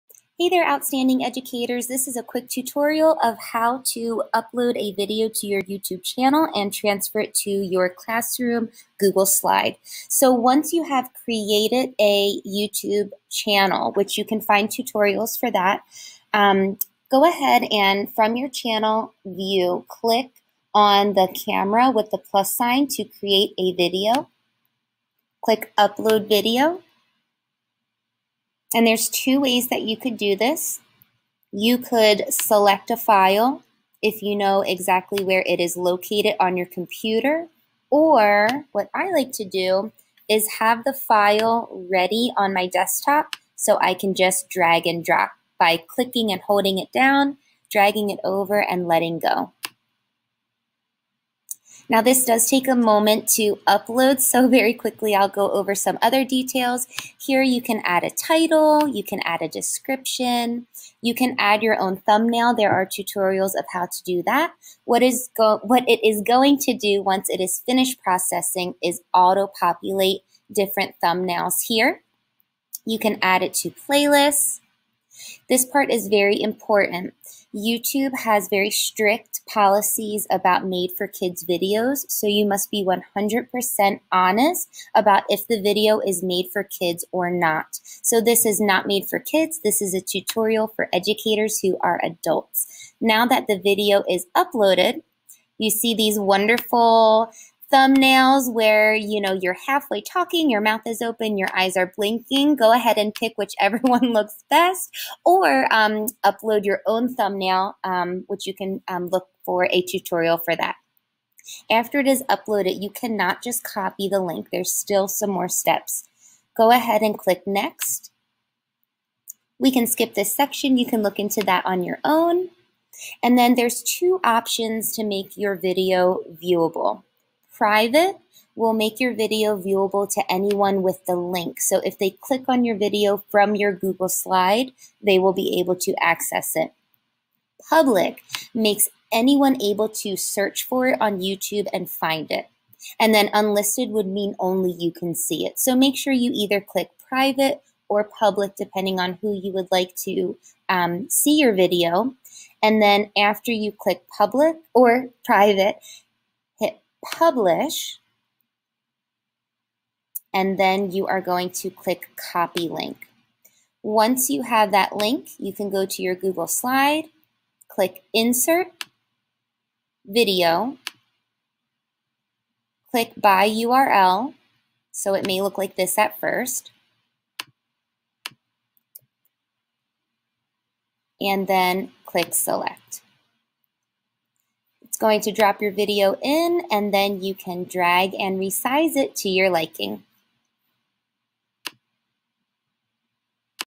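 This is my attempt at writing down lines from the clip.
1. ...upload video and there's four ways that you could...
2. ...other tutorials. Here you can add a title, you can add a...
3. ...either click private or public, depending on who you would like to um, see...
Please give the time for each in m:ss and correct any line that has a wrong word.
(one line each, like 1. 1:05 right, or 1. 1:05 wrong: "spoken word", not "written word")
1. 0:25 wrong: "two", not "four"
2. 0:56 wrong: "details", not "tutorials"
3. 2:26 right.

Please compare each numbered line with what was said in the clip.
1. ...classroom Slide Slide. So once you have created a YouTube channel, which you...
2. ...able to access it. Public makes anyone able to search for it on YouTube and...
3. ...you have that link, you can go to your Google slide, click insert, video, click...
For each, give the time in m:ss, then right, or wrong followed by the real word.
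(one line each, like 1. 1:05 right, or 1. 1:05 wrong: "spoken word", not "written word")
1. 0:07 wrong: "Google", not "Slide"
2. 2:15 right
3. 2:44 right.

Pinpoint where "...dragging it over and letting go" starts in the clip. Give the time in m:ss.
0:47.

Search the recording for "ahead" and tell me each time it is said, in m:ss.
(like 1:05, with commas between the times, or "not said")
0:17, 1:42, 1:56.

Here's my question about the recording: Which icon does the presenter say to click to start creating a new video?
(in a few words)
camera with the plus sign.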